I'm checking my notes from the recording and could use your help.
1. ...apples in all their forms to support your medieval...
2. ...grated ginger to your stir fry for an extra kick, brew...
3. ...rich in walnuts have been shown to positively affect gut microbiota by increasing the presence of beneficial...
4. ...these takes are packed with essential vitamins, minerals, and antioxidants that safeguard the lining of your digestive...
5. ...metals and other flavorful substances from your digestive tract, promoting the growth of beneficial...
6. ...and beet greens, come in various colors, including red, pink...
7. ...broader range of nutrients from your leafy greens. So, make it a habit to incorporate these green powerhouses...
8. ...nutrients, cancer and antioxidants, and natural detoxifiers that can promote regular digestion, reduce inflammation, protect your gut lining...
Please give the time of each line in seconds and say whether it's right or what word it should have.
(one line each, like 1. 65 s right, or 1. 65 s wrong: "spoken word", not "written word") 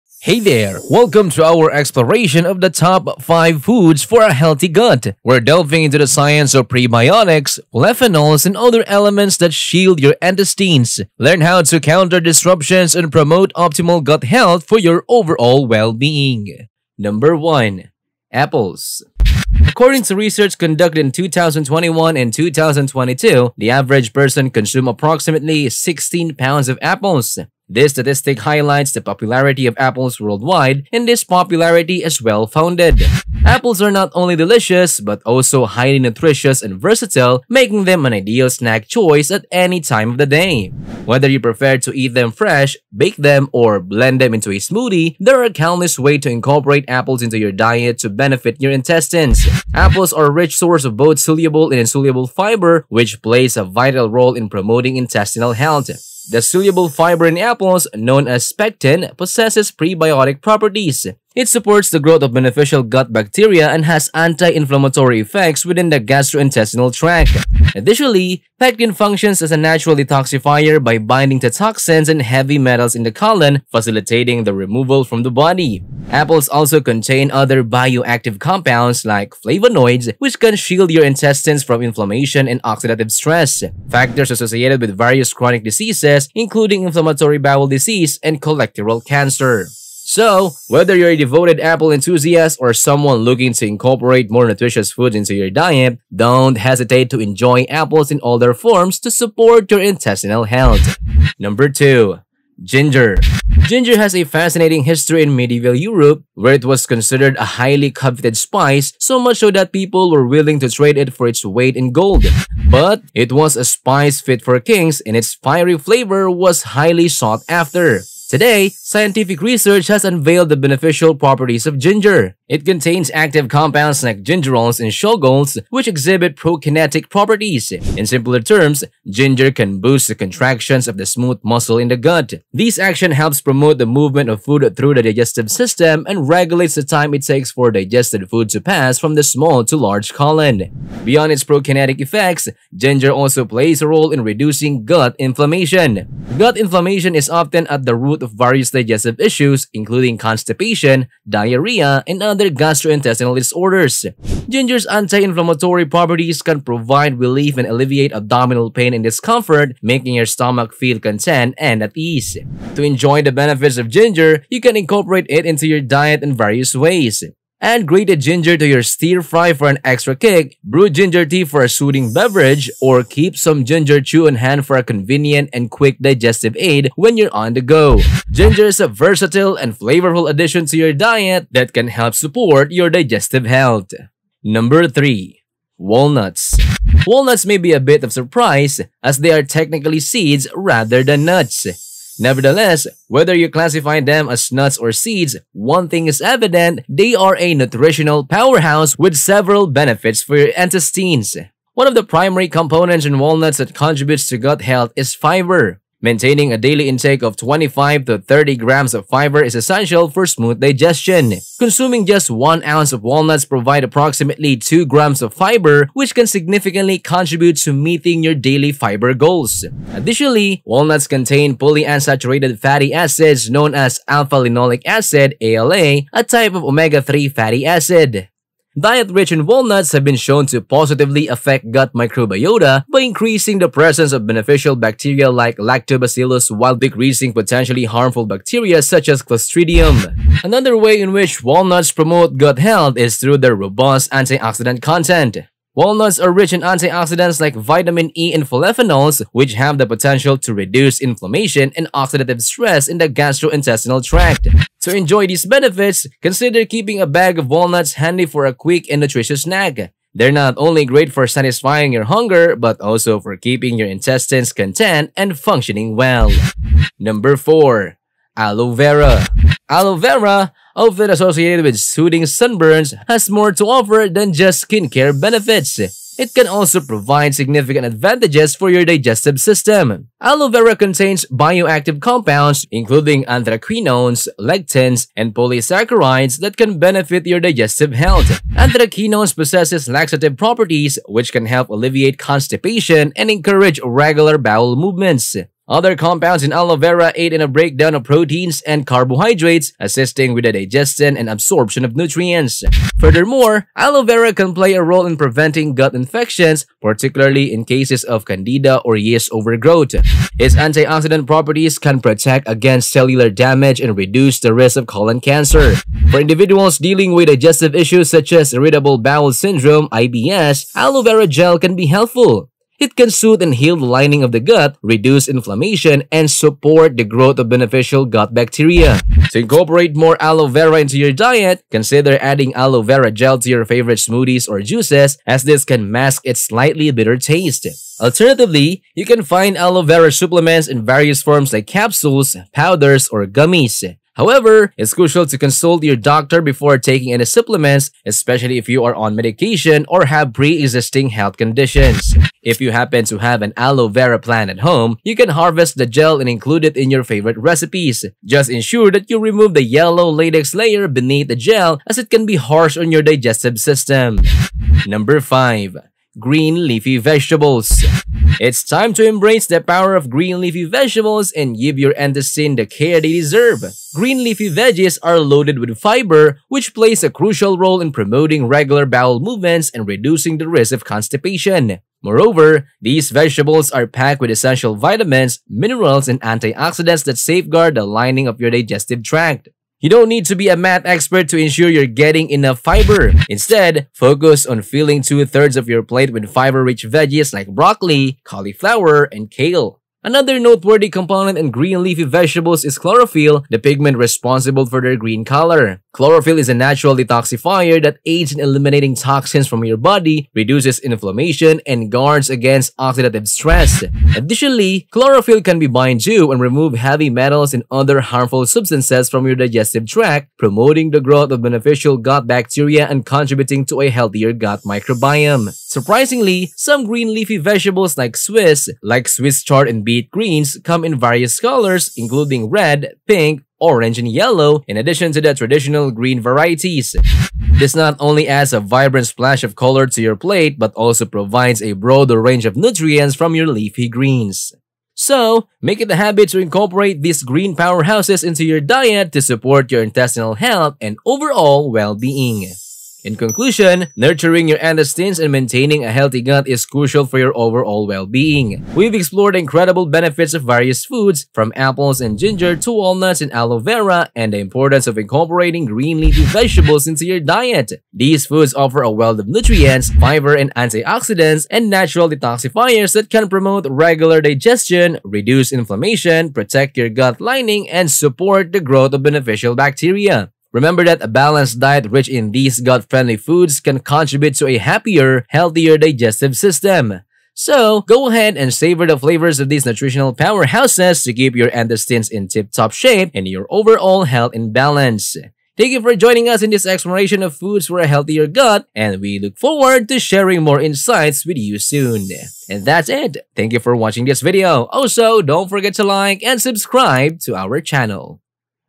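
1. 97 s wrong: "intestinal", not "medieval"
2. 167 s right
3. 229 s right
4. 382 s wrong: "vegetables", not "takes"
5. 417 s wrong: "harmful", not "flavorful"
6. 429 s right
7. 441 s right
8. 469 s wrong: "fiber", not "cancer".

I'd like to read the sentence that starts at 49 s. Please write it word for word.
Apples are a rich source of both soluble and insoluble fiber, which plays a vital role in promoting intestinal health.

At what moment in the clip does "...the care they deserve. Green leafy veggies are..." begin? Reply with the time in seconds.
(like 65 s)
372 s.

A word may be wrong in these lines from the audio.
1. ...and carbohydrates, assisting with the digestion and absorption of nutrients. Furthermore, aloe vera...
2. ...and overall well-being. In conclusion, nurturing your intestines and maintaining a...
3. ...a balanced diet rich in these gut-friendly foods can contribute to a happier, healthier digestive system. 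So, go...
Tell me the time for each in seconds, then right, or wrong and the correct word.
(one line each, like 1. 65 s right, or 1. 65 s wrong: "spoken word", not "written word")
1. 298 s right
2. 450 s right
3. 481 s right.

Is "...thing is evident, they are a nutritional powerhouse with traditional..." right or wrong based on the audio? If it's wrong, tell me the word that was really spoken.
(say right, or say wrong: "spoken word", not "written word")
wrong: "several", not "traditional".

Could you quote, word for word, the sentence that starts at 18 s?
Apples According to research conducted in 2021 and 2022, the average person consumed approximately 16 pounds of apples.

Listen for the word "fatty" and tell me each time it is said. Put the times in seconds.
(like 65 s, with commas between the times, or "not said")
222 s, 227 s.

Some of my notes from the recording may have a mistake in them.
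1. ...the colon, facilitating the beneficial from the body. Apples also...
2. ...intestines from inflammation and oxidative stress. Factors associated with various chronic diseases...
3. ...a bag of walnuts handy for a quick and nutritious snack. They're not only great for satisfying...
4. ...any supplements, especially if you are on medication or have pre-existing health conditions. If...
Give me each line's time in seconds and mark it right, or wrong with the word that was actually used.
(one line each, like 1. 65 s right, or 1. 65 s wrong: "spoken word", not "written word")
1. 73 s wrong: "removal", not "beneficial"
2. 81 s right
3. 256 s right
4. 347 s right.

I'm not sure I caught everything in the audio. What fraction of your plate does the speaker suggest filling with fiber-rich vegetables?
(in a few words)
two-thirds.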